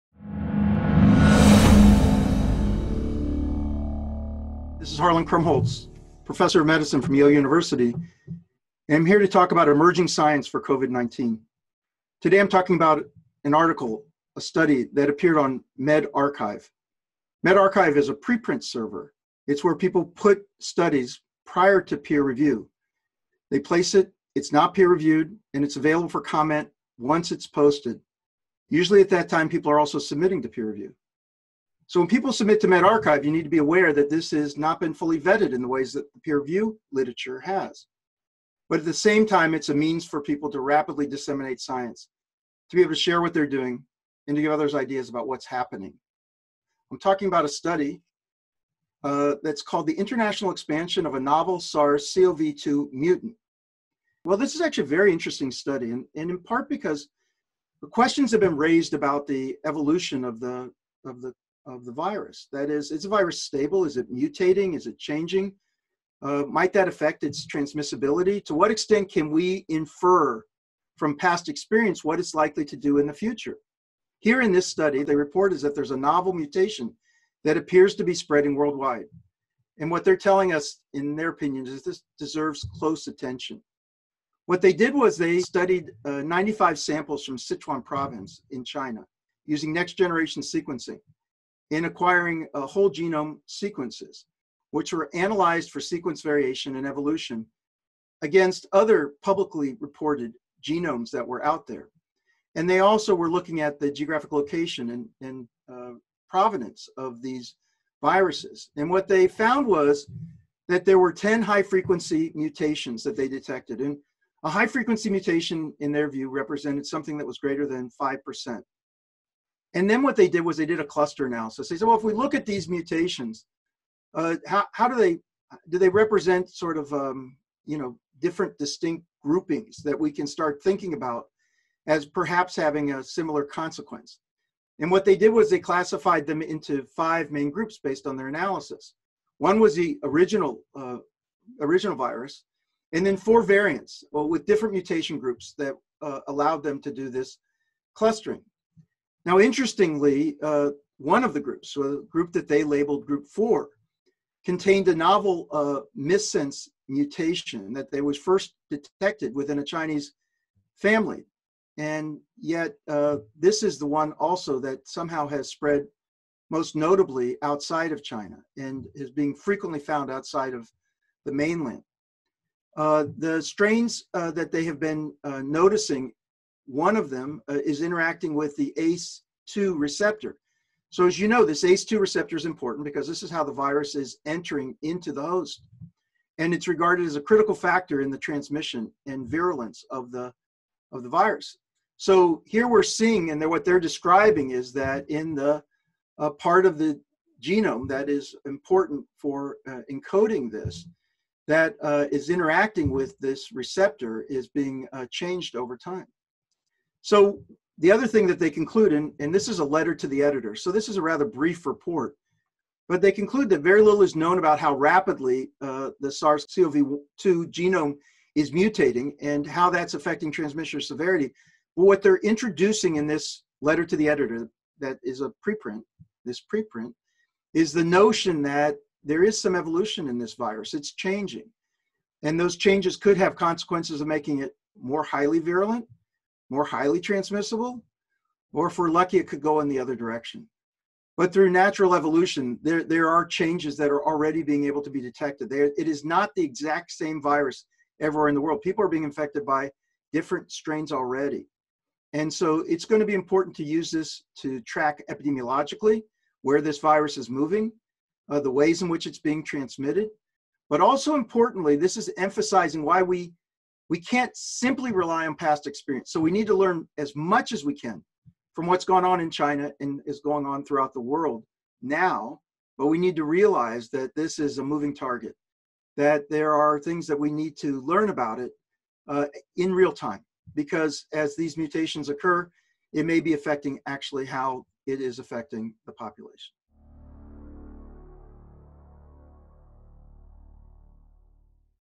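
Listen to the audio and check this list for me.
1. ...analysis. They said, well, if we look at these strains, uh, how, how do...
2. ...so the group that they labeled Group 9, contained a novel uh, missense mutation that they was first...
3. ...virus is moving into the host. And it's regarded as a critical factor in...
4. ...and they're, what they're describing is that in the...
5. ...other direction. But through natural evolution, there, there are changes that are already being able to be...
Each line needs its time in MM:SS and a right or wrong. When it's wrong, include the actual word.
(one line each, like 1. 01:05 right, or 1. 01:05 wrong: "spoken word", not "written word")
1. 02:01 wrong: "mutations", not "strains"
2. 02:31 wrong: "4", not "9"
3. 03:03 wrong: "entering", not "moving"
4. 03:13 right
5. 03:59 right.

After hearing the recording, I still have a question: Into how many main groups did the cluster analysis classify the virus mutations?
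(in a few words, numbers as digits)
5.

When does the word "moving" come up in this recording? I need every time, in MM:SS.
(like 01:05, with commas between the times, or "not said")
04:17, 04:34.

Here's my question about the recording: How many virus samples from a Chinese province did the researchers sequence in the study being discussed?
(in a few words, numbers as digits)
95.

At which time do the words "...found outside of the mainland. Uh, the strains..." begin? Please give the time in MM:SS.
02:49.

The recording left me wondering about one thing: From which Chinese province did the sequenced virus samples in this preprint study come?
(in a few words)
Sichuan.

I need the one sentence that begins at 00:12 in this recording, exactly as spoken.
Today I'm talking about an article, a study that appeared on medRxiv.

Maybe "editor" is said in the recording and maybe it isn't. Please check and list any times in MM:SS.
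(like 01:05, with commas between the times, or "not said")
03:30, 03:44.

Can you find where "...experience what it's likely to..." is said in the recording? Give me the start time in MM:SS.
01:11.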